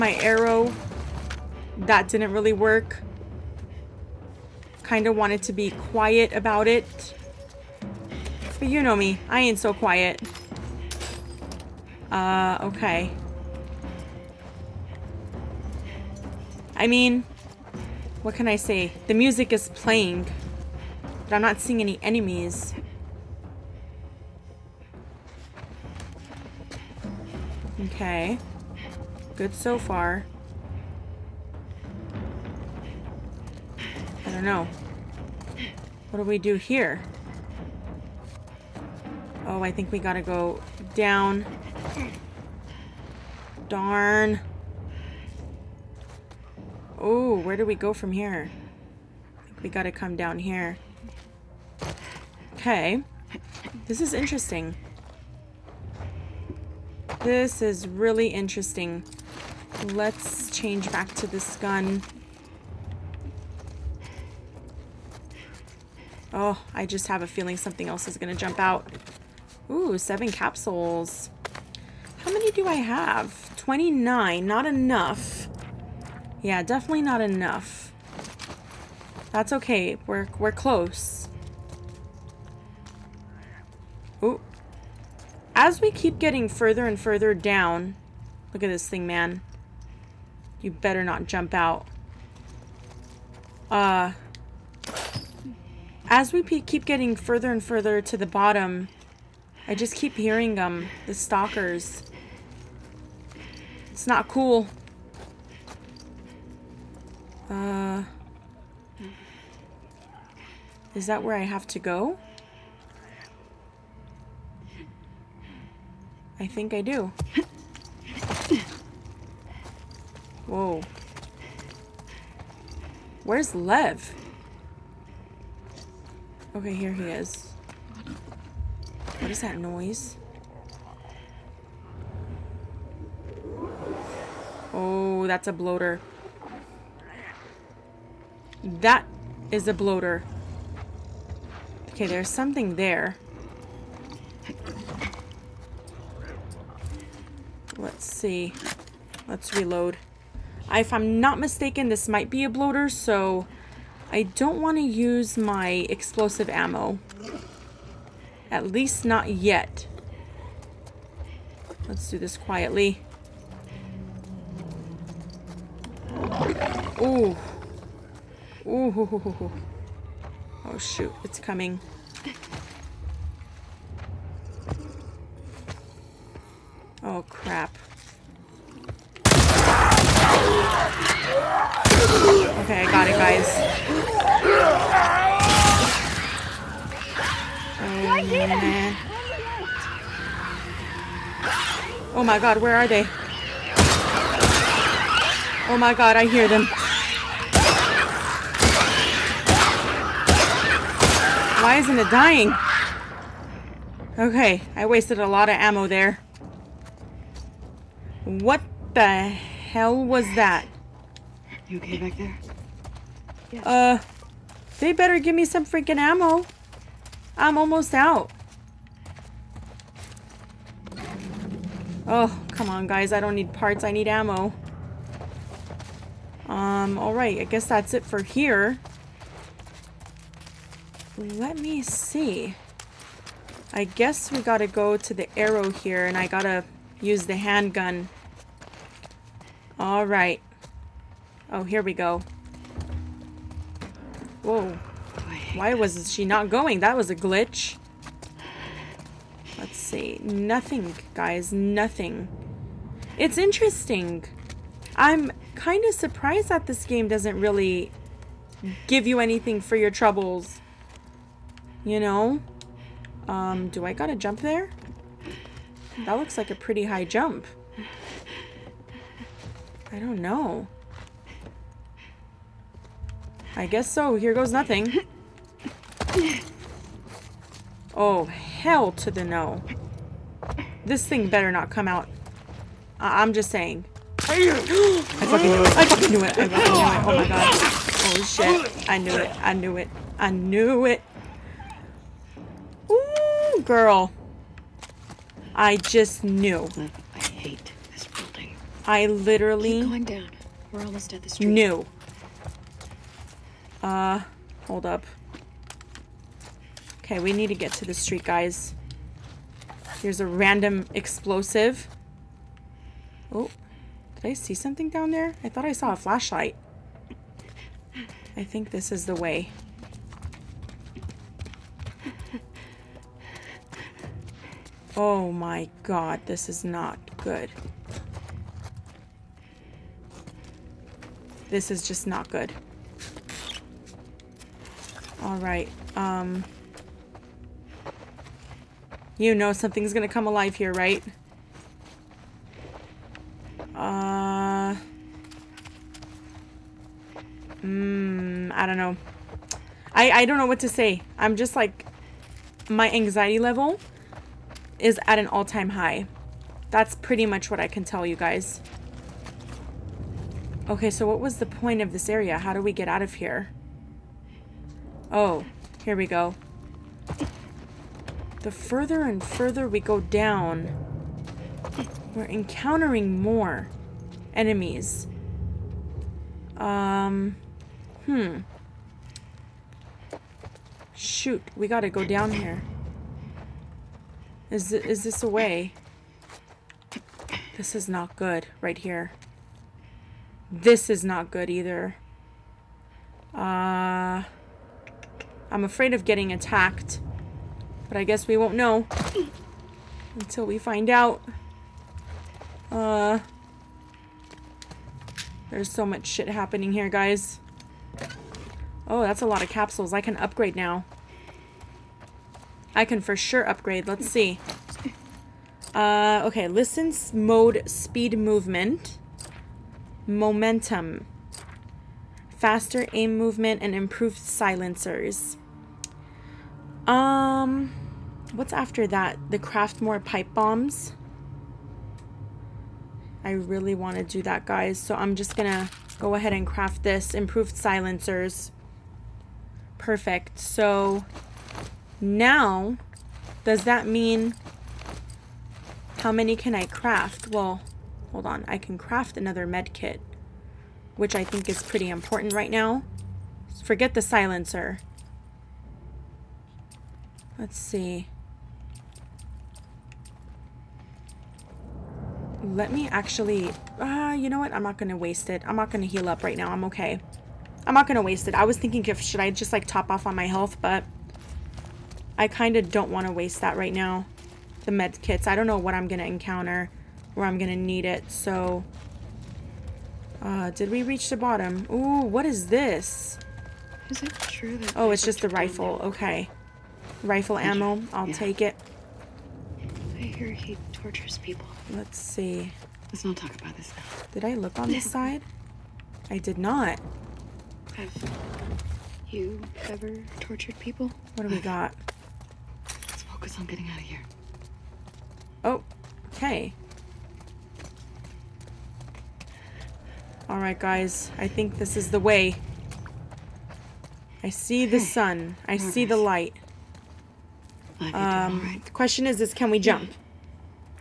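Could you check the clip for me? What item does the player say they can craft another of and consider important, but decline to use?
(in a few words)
Med kit.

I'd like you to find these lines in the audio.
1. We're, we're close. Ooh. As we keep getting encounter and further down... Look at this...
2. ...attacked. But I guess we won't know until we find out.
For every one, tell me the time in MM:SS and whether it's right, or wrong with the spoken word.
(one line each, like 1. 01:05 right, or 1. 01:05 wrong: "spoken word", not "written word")
1. 01:20 wrong: "further", not "encounter"
2. 06:36 right.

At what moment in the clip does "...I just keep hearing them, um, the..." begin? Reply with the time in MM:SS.
01:39.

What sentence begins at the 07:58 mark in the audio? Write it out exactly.
So uh, did we reach the bottom?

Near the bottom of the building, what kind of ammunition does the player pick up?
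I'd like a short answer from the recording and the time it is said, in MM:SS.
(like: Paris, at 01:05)
Rifle ammo, at 08:07.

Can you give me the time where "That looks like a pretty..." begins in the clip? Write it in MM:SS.
04:26.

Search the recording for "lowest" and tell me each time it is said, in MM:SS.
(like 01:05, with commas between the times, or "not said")
not said.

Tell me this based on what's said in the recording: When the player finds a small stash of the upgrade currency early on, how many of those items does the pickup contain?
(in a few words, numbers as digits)
7.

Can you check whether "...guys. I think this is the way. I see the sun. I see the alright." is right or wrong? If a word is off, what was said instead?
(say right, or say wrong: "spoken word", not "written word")
wrong: "light", not "alright".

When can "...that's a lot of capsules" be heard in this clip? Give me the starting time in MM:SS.
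06:49.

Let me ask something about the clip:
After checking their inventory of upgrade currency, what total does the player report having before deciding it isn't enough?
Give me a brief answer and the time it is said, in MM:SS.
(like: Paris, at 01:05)
29, at 01:13.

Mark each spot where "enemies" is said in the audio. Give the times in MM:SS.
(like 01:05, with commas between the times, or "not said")
00:22, 06:14.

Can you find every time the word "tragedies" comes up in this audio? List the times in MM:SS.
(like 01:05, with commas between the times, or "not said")
not said.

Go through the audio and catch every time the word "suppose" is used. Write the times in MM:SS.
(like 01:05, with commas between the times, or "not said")
not said.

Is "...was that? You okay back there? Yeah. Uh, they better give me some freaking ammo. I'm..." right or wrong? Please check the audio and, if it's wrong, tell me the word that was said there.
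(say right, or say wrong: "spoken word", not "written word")
right.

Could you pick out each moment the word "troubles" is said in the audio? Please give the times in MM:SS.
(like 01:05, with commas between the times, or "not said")
04:19.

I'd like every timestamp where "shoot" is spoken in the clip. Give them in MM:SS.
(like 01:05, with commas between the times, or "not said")
02:50, 06:20.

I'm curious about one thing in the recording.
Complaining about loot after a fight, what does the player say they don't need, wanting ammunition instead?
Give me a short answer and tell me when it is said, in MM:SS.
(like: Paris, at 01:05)
Parts, at 03:43.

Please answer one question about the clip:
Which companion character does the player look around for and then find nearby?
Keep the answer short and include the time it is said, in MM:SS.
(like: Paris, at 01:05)
Lev, at 02:03.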